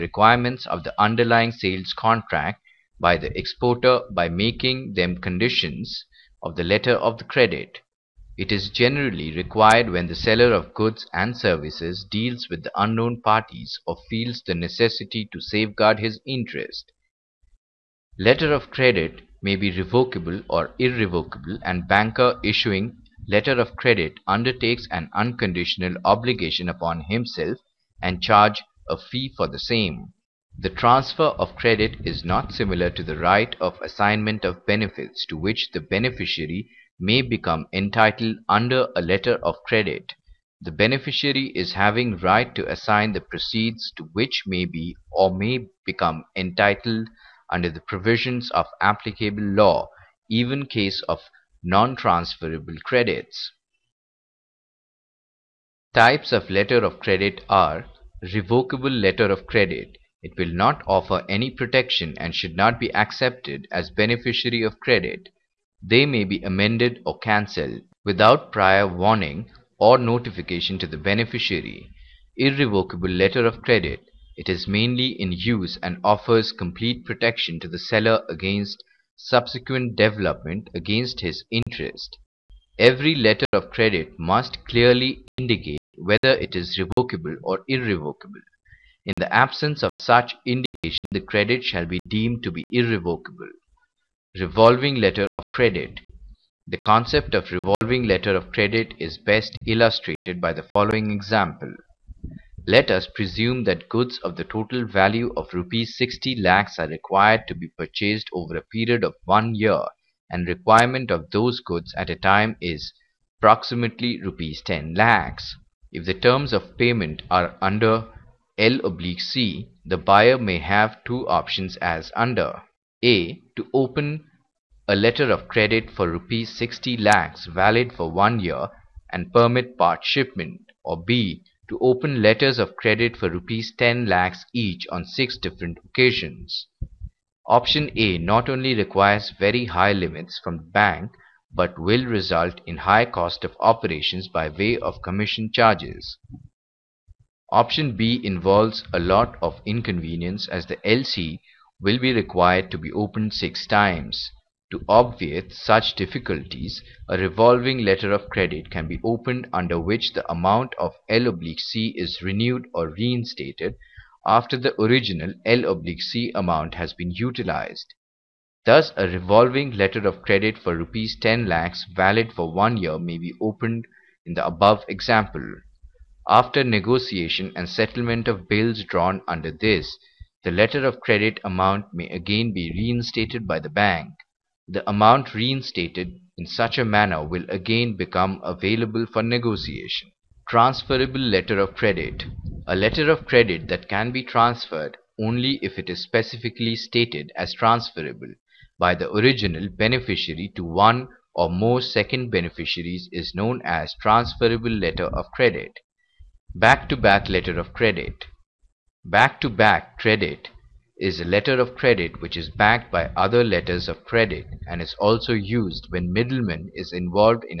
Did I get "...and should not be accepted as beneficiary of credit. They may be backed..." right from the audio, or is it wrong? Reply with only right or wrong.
wrong.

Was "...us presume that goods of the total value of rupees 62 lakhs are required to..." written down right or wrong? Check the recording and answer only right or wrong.
wrong.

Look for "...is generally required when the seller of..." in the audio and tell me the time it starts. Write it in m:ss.
0:08.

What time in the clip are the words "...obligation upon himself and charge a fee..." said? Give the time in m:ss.
0:26.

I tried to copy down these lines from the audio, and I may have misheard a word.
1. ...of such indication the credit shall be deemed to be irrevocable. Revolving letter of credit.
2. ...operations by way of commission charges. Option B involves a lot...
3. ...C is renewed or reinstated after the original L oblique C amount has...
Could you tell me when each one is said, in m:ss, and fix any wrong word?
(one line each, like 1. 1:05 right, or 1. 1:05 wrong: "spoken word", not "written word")
1. 1:29 right
2. 2:23 right
3. 2:41 right.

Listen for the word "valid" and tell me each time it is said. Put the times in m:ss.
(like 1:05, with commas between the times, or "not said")
2:07, 2:51.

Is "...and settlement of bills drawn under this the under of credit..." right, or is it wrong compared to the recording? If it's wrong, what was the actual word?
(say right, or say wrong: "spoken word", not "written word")
wrong: "letter", not "under".